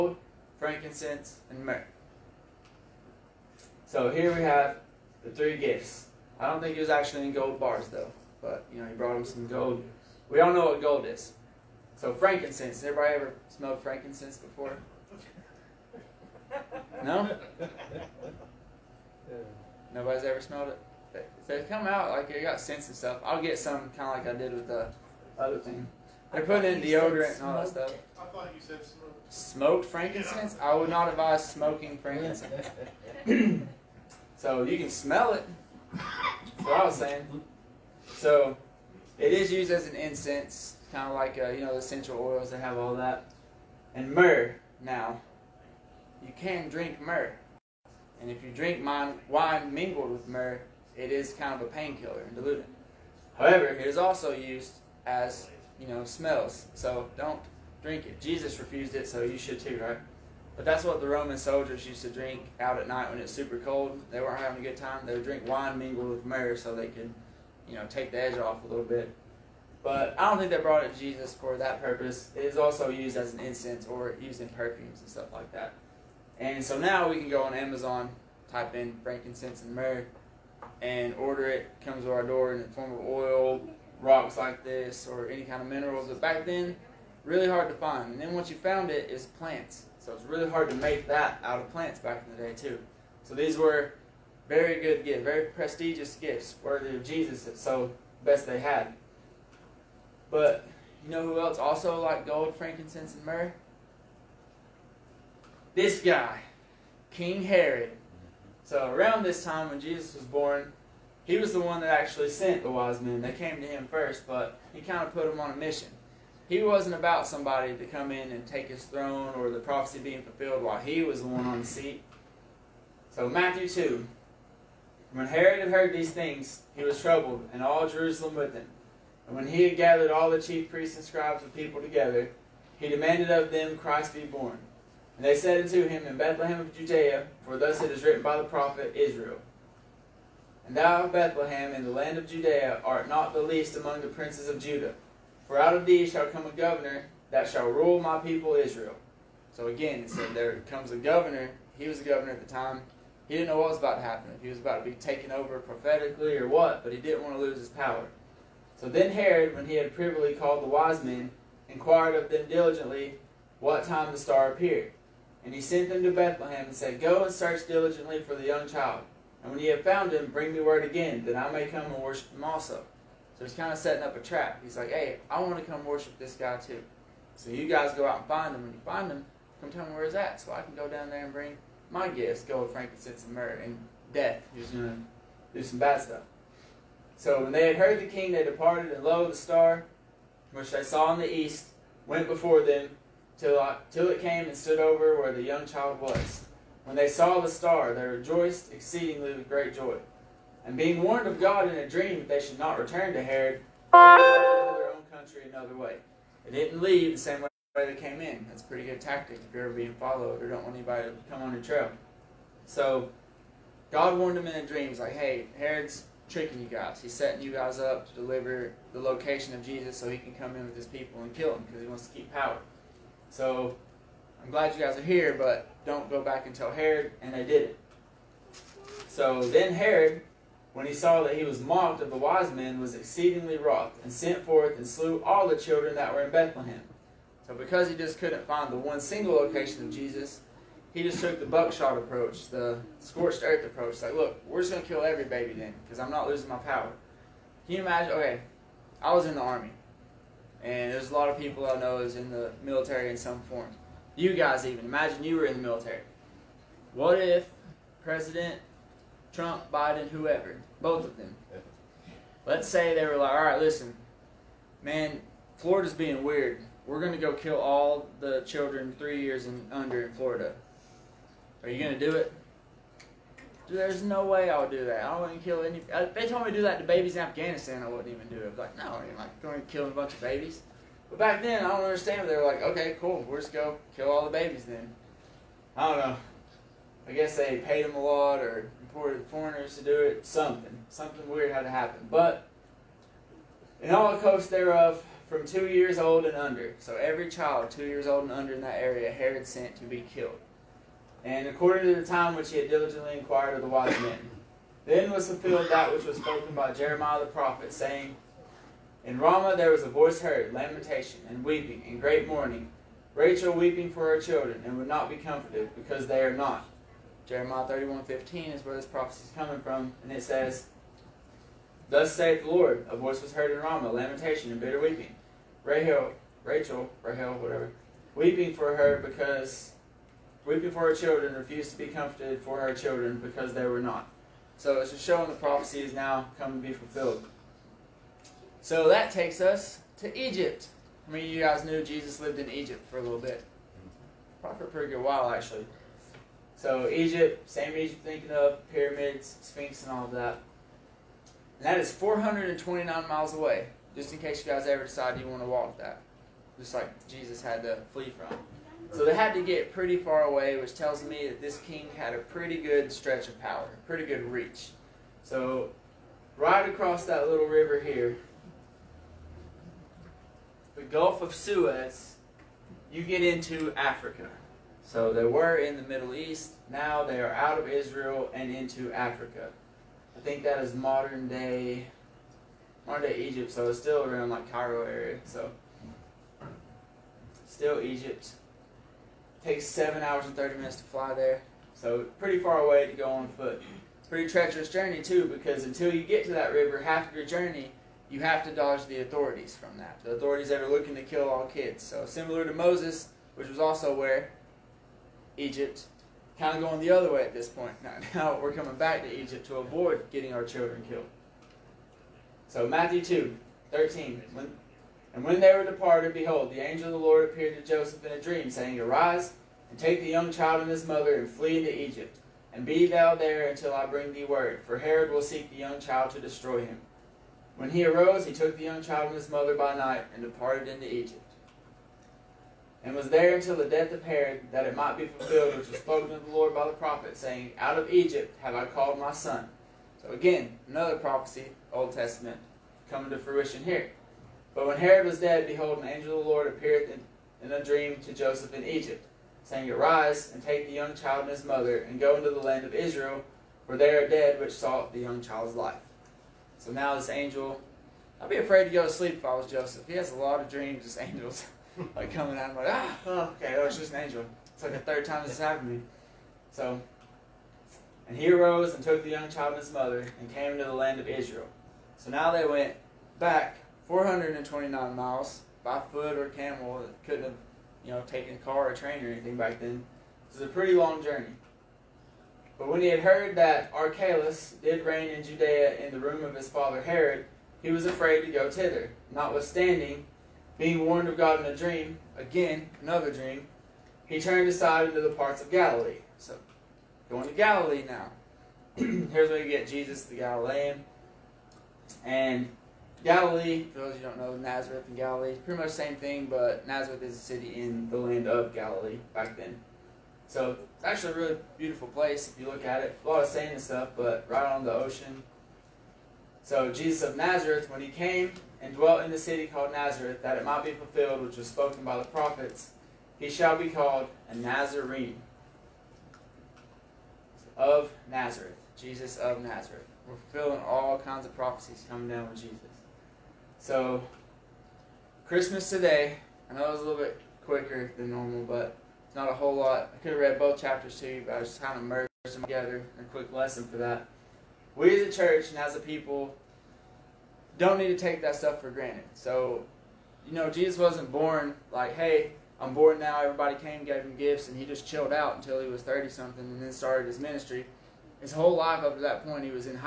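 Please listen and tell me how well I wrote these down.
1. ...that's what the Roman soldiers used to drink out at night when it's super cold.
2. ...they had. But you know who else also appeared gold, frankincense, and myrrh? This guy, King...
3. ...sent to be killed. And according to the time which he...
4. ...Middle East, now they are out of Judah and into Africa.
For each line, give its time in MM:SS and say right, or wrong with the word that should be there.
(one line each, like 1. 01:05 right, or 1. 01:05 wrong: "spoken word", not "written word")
1. 01:00 right
2. 01:38 wrong: "liked", not "appeared"
3. 04:59 right
4. 06:15 wrong: "Israel", not "Judah".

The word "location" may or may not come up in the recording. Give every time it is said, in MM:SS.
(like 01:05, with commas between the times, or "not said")
03:38, 03:59.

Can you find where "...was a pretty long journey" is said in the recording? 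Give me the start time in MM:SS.
08:00.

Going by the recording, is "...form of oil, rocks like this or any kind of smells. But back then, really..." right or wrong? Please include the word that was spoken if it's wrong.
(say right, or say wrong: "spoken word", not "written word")
wrong: "minerals", not "smells".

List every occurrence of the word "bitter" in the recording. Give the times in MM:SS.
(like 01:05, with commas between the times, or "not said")
05:24.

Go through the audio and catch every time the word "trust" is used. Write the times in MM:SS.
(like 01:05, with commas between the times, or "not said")
not said.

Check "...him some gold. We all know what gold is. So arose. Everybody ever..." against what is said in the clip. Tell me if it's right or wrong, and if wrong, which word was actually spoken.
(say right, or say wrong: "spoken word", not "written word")
wrong: "frankincense", not "arose".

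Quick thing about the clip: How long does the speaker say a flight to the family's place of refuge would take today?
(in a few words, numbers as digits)
7 hours 30 minutes.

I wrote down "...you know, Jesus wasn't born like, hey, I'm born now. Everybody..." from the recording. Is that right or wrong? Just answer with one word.
right.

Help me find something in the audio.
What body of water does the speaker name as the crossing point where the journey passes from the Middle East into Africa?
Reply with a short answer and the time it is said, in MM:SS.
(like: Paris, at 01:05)
Gulf of Suez, at 06:10.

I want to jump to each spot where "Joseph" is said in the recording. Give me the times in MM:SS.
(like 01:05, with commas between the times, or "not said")
06:57, 07:28, 07:39.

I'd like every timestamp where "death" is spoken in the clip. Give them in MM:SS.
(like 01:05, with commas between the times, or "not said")
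03:04, 07:13.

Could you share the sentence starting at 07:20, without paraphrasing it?
So again, another prophecy, Old Testament, coming to fruition here.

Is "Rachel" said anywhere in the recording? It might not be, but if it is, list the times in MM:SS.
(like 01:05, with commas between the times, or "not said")
05:13, 05:26.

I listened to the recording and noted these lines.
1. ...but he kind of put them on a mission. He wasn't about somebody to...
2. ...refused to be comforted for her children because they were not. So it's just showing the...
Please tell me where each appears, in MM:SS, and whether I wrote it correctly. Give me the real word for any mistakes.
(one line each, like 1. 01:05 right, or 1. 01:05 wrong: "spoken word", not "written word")
1. 01:54 right
2. 05:31 right.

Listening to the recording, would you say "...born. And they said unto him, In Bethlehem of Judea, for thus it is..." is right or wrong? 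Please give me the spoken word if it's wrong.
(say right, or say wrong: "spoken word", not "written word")
right.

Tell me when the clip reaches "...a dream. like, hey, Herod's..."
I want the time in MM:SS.
03:34.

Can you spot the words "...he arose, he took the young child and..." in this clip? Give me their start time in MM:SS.
07:07.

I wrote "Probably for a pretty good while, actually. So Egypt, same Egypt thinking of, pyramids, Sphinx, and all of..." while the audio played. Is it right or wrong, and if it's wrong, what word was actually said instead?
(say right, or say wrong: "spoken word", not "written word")
right.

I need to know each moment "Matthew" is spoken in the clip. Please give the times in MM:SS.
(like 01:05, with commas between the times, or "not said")
02:03, 06:52.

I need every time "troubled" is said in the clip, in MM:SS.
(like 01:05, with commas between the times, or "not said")
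02:07.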